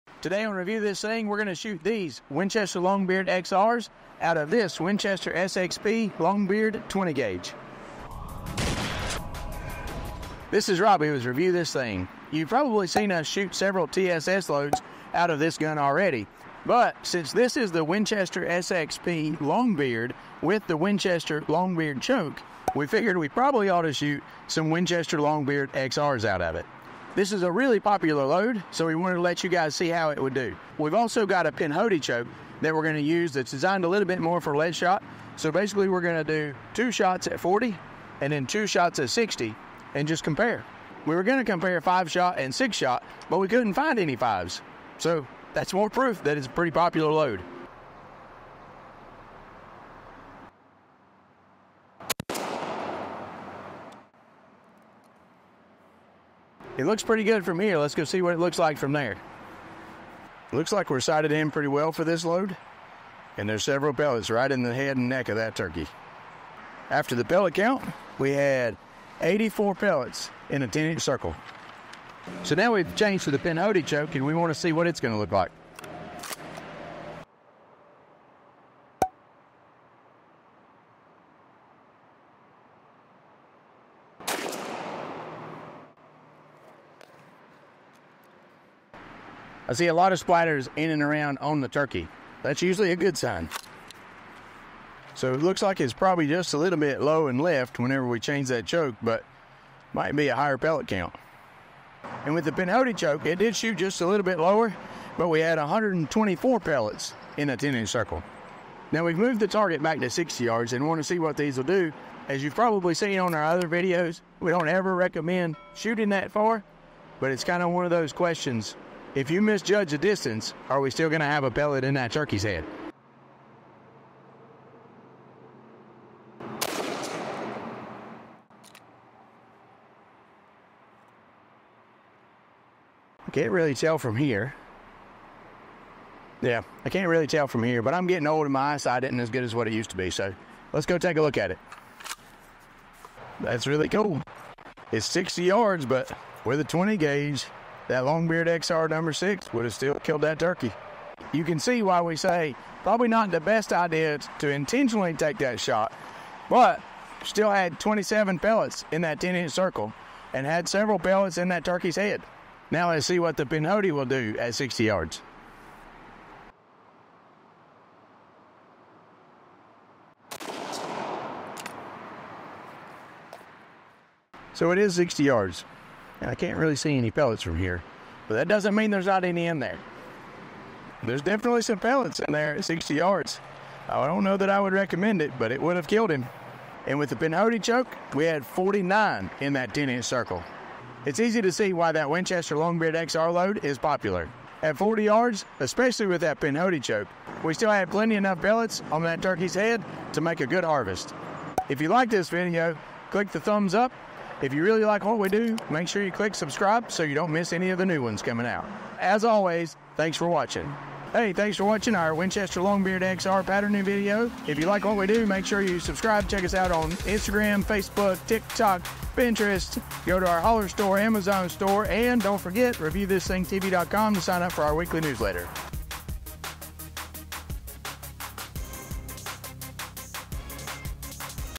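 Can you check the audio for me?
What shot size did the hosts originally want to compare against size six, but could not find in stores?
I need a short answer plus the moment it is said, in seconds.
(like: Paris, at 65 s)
5, at 41 s.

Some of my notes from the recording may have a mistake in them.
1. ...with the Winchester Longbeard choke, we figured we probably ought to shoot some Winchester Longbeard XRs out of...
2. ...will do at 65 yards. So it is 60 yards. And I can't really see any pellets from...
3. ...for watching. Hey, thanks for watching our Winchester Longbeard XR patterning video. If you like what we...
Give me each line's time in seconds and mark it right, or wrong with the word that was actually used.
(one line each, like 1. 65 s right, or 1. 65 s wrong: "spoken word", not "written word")
1. 20 s right
2. 163 s wrong: "60", not "65"
3. 210 s right.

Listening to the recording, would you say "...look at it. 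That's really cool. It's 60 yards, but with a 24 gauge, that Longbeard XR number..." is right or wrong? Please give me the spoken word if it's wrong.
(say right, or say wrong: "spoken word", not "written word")
wrong: "20", not "24".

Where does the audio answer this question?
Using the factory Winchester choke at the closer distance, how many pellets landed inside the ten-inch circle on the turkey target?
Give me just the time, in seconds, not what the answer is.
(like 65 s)
69 s.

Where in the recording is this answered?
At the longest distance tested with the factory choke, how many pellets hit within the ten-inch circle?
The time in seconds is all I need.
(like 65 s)
157 s.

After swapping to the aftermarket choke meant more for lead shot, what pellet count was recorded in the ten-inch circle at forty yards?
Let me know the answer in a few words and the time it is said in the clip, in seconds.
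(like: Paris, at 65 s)
124, at 105 s.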